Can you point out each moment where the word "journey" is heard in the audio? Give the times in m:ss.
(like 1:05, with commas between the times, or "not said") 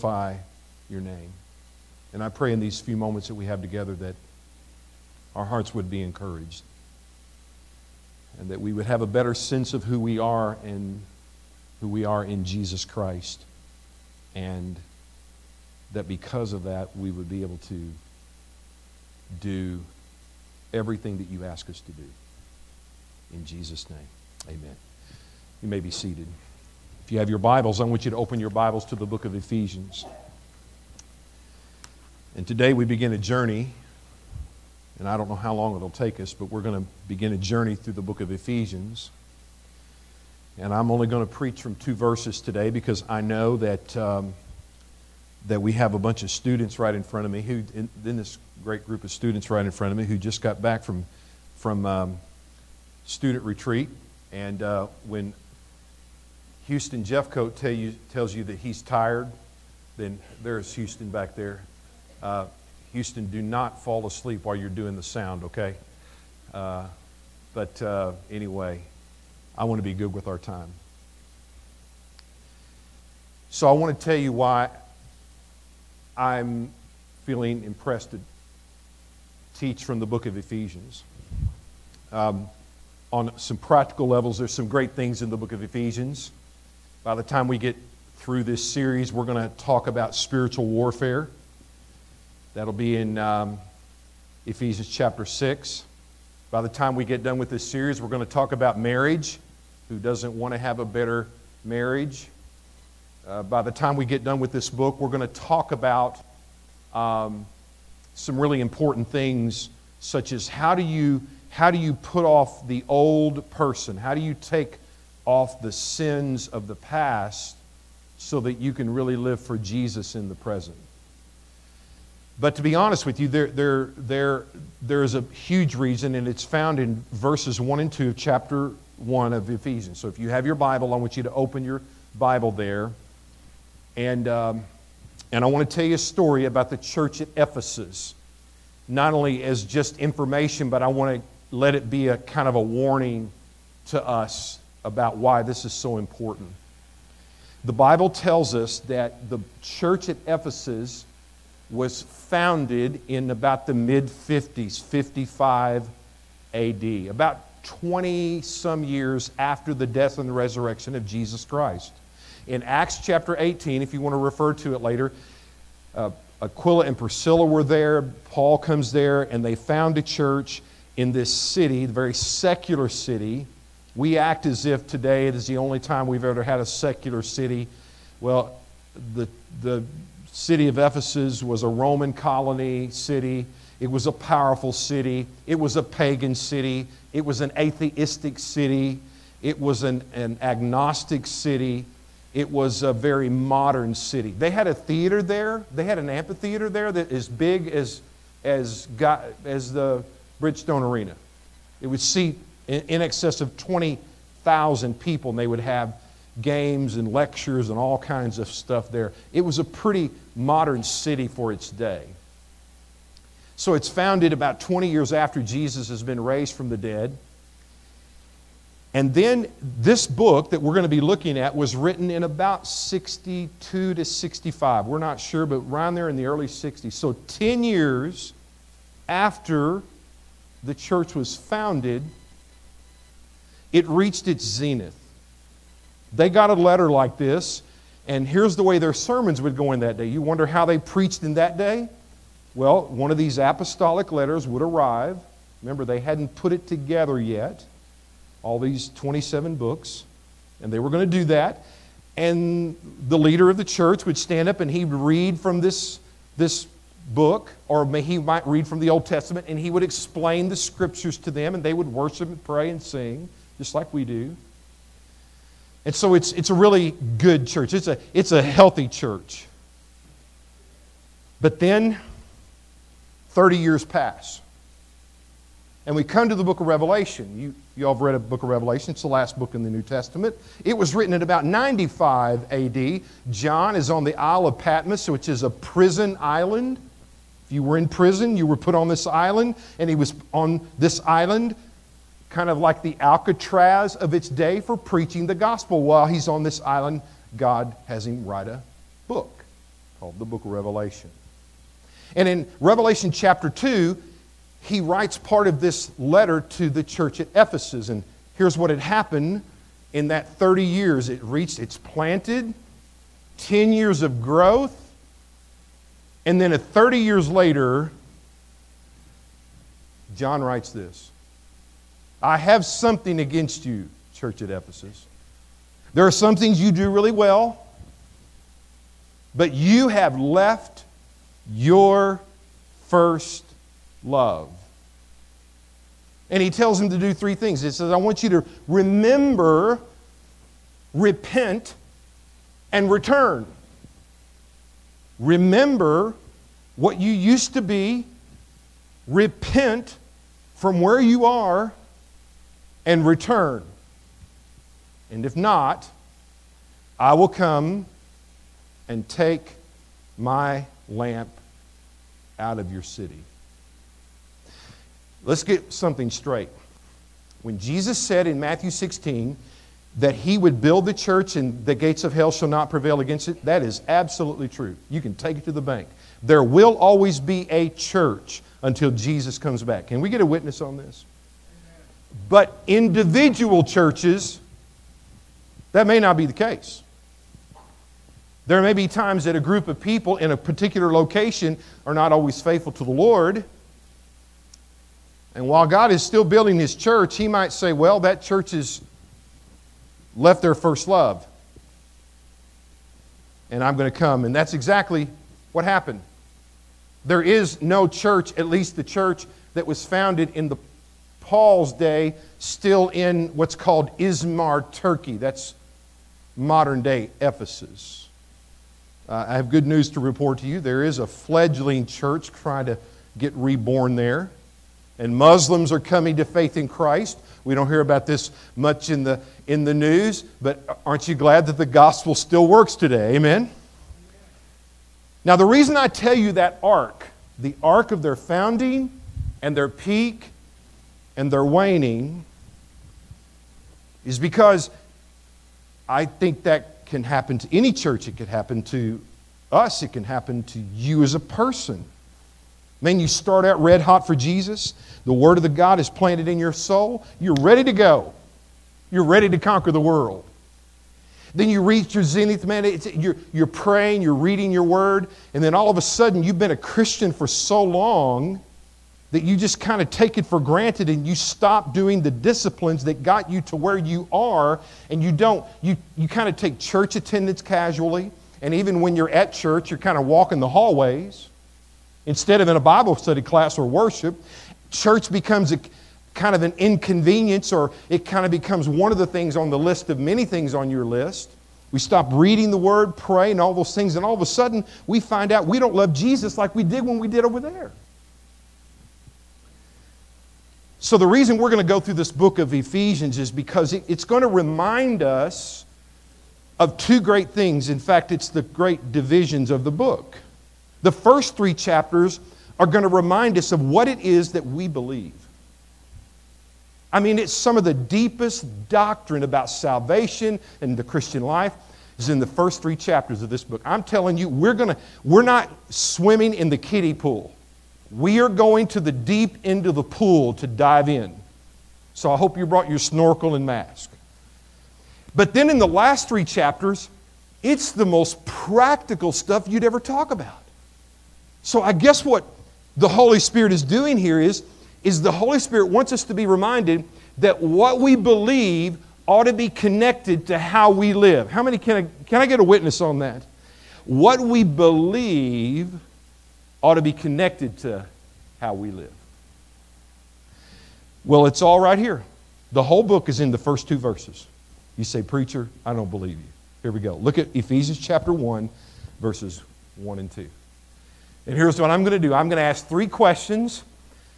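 0:33, 0:37.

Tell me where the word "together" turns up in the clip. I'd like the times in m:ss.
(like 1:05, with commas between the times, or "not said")
0:03, 4:06.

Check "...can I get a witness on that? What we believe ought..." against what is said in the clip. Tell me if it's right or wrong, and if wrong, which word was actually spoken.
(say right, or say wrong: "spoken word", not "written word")
right.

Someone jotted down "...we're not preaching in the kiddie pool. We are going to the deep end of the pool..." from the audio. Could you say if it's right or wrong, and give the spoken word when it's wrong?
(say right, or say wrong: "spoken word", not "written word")
wrong: "swimming", not "preaching".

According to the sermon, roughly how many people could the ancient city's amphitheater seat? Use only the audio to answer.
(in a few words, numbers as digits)
20,000.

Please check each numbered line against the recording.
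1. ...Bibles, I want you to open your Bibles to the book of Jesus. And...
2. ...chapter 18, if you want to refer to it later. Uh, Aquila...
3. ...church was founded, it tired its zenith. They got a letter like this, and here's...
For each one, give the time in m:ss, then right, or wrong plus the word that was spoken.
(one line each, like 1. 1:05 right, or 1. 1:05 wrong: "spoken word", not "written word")
1. 0:27 wrong: "Ephesians", not "Jesus"
2. 2:42 right
3. 3:50 wrong: "reached", not "tired".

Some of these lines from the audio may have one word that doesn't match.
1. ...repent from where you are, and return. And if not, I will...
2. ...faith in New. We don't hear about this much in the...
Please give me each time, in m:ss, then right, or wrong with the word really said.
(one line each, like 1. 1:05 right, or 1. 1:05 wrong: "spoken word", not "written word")
1. 5:49 right
2. 7:06 wrong: "Christ", not "New".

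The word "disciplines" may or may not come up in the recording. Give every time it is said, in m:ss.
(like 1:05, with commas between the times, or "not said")
7:52.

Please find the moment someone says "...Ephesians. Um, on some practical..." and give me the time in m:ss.
1:20.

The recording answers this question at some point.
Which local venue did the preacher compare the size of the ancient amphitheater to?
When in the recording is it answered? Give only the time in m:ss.
3:20.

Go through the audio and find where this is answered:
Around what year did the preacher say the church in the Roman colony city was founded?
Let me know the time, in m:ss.
2:34.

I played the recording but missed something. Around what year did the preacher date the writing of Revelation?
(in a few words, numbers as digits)
95 AD.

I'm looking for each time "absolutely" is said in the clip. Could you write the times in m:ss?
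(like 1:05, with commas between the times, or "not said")
6:13.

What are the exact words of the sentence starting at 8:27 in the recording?
In fact, it's the great divisions of the book.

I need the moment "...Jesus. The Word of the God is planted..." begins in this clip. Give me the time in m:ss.
7:34.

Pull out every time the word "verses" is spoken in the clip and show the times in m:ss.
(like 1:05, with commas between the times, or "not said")
0:41, 2:07, 9:23, 9:29.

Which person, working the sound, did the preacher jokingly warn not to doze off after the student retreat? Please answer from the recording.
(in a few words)
Houston Jeffcoat.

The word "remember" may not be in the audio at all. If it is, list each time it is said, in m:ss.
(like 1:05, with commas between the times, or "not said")
4:05, 5:38, 5:45.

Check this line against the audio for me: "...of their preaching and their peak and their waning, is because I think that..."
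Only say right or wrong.
wrong.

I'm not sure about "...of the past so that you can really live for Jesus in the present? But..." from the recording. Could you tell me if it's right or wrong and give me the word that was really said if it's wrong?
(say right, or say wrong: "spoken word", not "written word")
right.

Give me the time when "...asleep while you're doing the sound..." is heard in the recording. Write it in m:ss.
1:04.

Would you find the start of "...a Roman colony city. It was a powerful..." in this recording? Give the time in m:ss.
3:01.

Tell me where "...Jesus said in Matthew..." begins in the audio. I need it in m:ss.
6:07.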